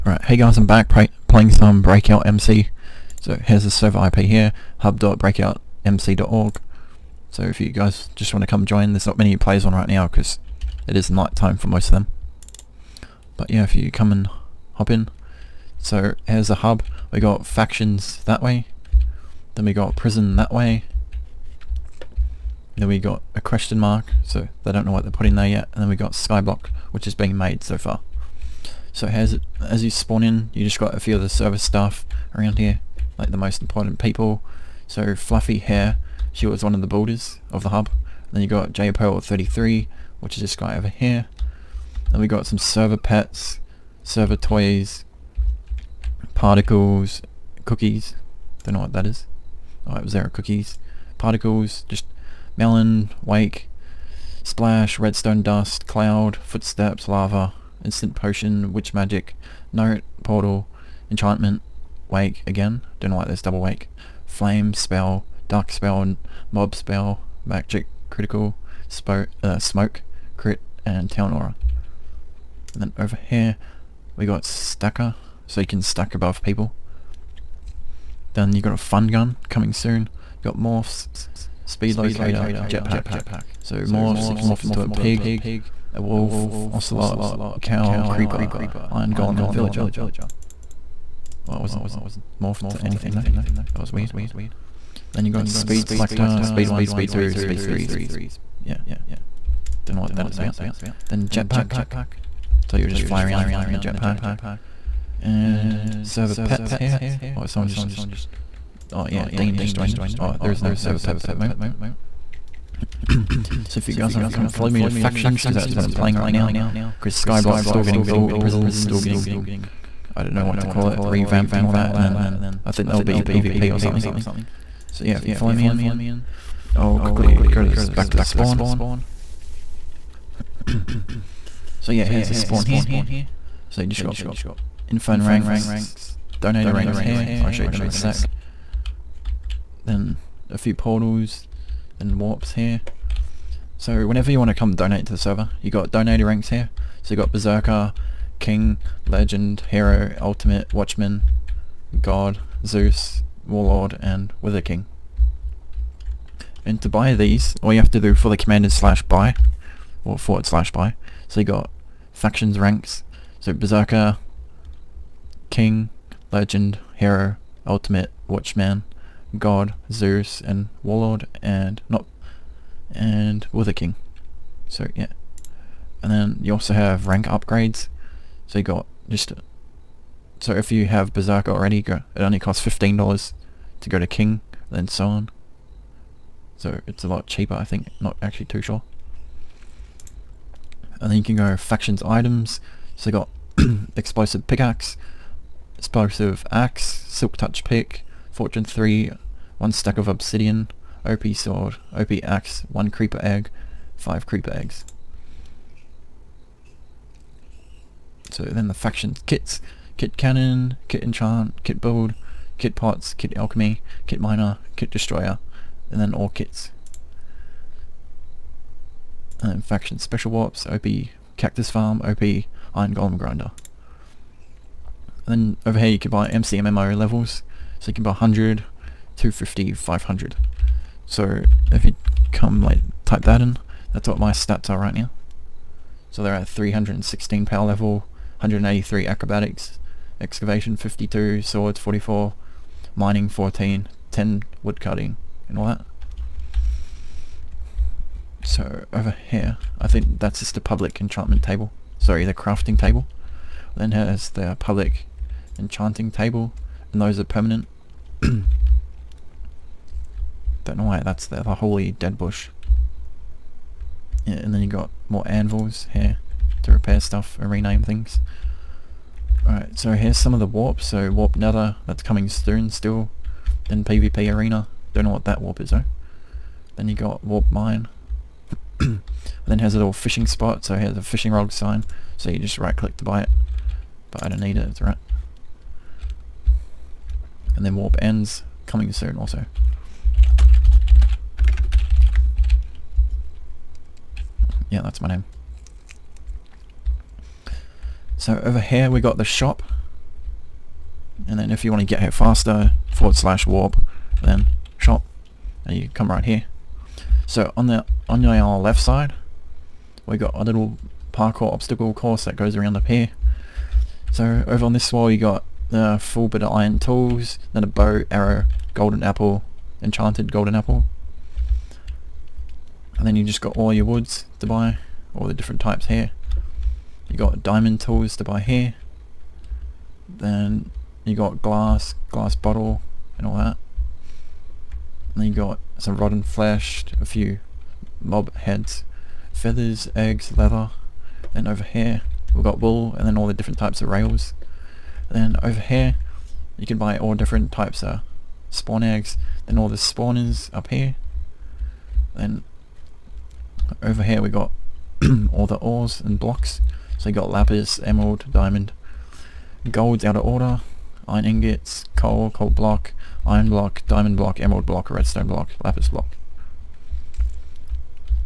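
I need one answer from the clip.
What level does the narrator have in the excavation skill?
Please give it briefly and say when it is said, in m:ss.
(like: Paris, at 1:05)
52, at 4:00.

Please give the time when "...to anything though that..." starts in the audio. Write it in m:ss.
1:32.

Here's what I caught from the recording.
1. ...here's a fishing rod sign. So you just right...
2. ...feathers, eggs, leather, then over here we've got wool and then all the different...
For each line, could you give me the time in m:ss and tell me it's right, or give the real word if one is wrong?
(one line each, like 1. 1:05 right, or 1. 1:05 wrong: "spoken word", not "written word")
1. 4:40 right
2. 5:39 right.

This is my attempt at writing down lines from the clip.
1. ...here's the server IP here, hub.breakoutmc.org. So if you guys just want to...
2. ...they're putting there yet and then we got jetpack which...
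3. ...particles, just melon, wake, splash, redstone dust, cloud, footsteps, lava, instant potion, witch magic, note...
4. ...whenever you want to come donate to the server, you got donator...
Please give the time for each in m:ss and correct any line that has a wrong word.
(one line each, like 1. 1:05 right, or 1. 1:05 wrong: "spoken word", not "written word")
1. 0:03 right
2. 0:25 wrong: "skyblock", not "jetpack"
3. 0:51 right
4. 2:24 right.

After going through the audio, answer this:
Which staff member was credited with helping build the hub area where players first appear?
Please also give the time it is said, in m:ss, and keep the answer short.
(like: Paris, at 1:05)
Fluffy Hair, at 0:35.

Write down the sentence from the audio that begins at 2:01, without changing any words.
And then I think there'll be PvP or something.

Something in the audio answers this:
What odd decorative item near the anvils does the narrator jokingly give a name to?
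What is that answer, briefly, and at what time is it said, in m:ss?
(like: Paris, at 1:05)
the holy dead bush, at 4:21.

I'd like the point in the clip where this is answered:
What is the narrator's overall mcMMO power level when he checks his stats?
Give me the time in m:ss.
3:56.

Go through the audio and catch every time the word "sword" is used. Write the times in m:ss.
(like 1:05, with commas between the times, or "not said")
3:21, 4:01.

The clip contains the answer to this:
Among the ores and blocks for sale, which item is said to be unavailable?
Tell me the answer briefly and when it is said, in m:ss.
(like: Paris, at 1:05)
gold, at 5:59.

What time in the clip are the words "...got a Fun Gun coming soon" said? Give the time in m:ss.
1:18.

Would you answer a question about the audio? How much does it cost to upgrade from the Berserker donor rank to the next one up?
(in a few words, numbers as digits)
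$15.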